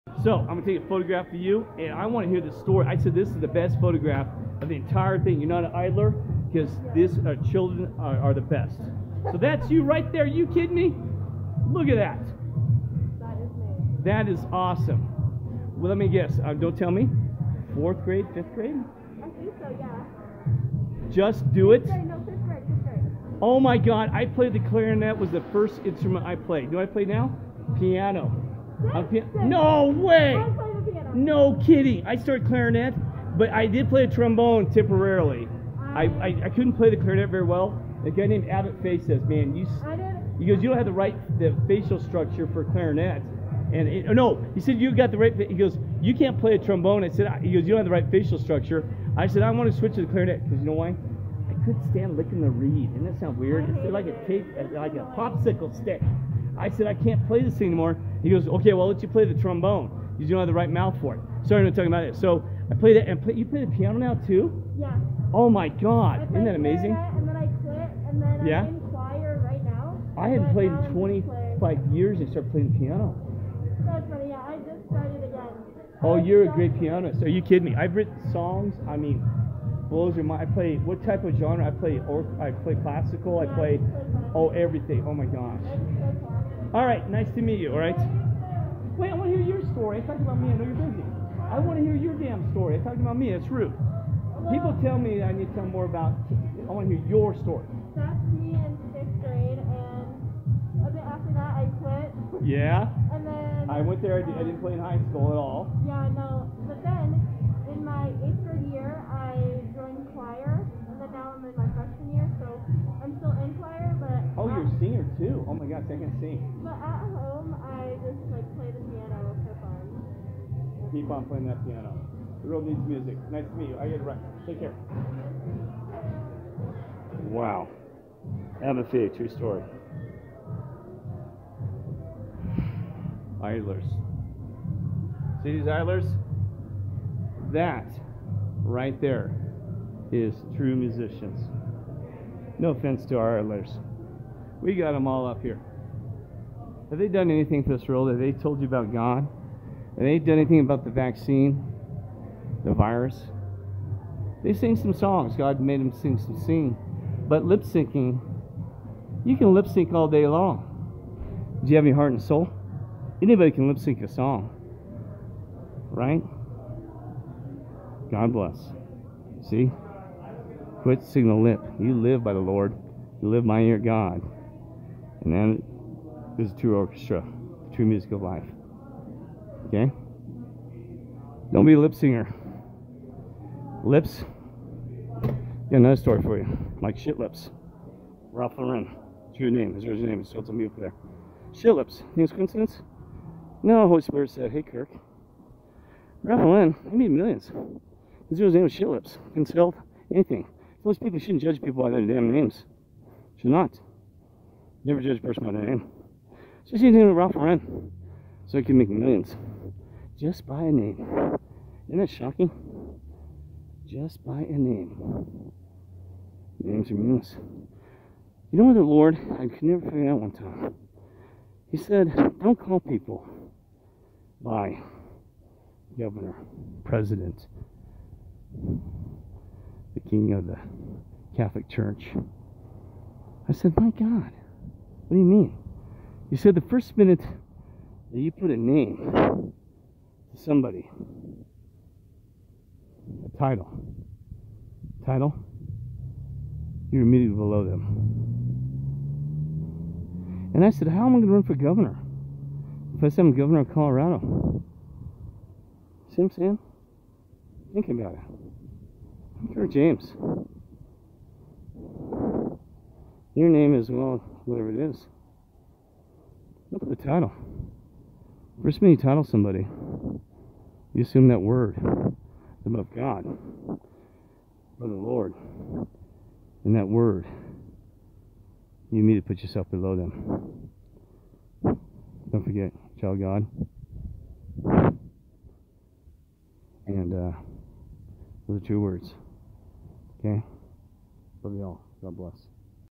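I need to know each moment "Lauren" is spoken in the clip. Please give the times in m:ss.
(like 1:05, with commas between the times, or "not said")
3:08, 3:16, 3:27.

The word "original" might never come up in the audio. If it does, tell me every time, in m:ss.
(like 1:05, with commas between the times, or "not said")
3:09.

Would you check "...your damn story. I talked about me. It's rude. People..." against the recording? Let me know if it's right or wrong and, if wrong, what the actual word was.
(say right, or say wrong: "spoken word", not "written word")
right.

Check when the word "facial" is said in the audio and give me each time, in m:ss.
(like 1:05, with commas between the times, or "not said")
0:41, 0:48.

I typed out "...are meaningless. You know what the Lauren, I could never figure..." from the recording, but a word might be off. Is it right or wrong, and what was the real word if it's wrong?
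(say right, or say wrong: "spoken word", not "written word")
wrong: "Lord", not "Lauren".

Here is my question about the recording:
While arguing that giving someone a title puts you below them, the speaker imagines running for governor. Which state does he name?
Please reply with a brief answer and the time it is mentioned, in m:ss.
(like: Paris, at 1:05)
Colorado, at 4:13.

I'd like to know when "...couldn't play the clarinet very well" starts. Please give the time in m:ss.
0:36.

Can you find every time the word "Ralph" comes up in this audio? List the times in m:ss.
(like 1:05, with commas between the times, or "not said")
3:08, 3:16, 3:27.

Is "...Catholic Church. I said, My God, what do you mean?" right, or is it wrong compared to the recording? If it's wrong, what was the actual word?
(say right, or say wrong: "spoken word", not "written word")
right.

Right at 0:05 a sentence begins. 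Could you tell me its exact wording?
You're not an idler because these uh, children are, are, the best.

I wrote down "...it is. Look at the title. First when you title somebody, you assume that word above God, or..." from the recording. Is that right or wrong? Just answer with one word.
right.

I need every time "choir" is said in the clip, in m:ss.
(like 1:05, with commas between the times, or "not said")
1:08.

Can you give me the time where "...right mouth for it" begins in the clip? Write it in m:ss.
1:00.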